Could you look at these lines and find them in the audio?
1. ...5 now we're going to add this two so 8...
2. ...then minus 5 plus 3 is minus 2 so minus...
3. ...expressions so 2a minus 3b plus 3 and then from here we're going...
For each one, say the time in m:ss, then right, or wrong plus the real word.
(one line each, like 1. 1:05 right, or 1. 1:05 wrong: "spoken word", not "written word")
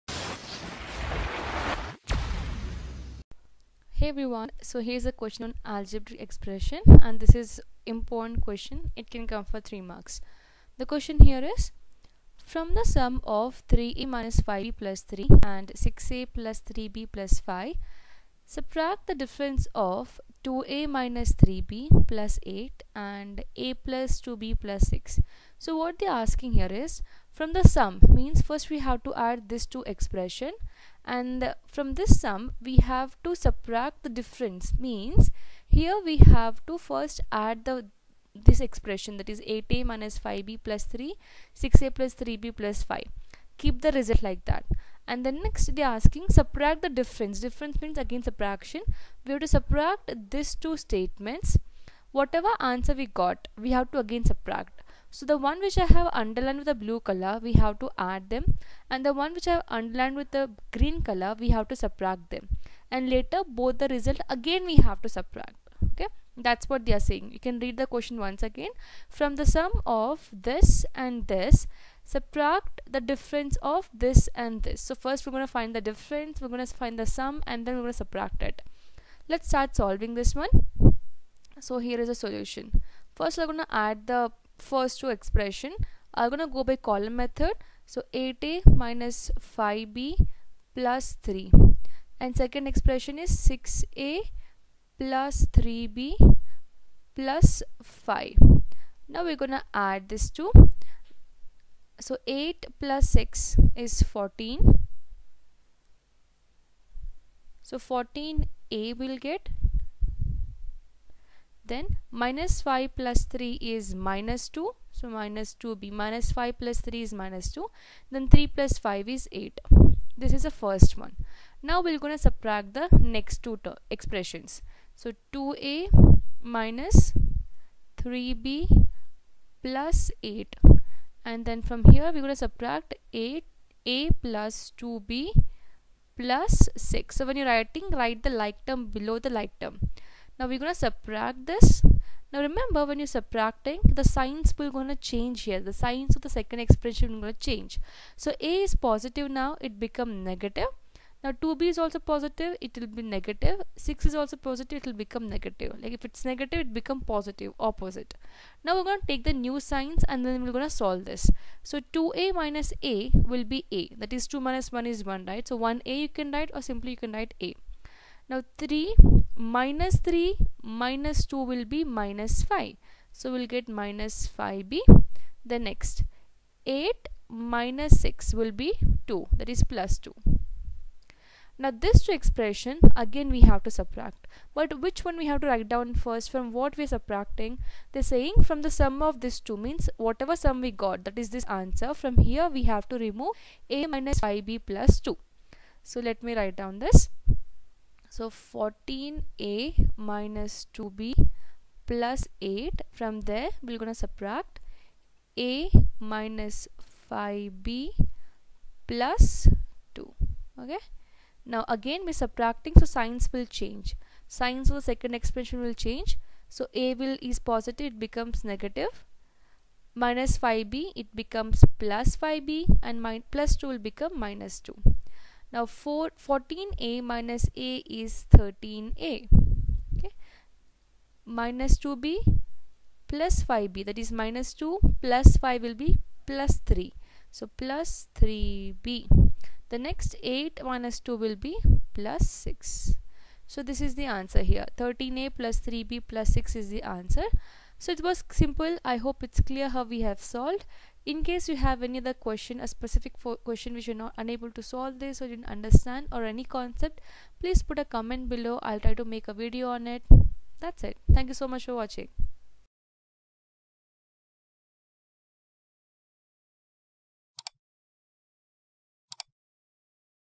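1. 1:37 right
2. 1:51 right
3. 2:03 wrong: "8", not "3".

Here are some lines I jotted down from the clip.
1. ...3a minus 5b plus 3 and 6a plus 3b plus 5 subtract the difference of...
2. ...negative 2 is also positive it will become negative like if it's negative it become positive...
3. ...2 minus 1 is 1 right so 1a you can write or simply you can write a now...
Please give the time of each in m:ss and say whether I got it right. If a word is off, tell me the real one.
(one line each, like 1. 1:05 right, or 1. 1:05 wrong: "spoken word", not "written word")
1. 0:13 right
2. 2:33 wrong: "6", not "2"
3. 2:44 right.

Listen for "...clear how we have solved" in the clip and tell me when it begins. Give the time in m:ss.
4:09.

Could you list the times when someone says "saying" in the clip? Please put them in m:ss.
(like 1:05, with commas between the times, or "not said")
1:07, 3:08.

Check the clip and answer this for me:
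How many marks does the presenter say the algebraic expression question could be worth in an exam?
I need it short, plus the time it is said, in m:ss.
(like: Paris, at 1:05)
3 marks, at 0:09.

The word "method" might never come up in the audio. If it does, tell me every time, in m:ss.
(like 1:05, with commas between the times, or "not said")
1:27.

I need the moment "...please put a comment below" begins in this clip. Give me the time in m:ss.
4:17.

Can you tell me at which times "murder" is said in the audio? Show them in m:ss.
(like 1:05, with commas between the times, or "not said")
not said.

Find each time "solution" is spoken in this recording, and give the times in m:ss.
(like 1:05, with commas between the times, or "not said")
1:22.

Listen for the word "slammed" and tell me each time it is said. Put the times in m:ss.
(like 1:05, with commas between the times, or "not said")
not said.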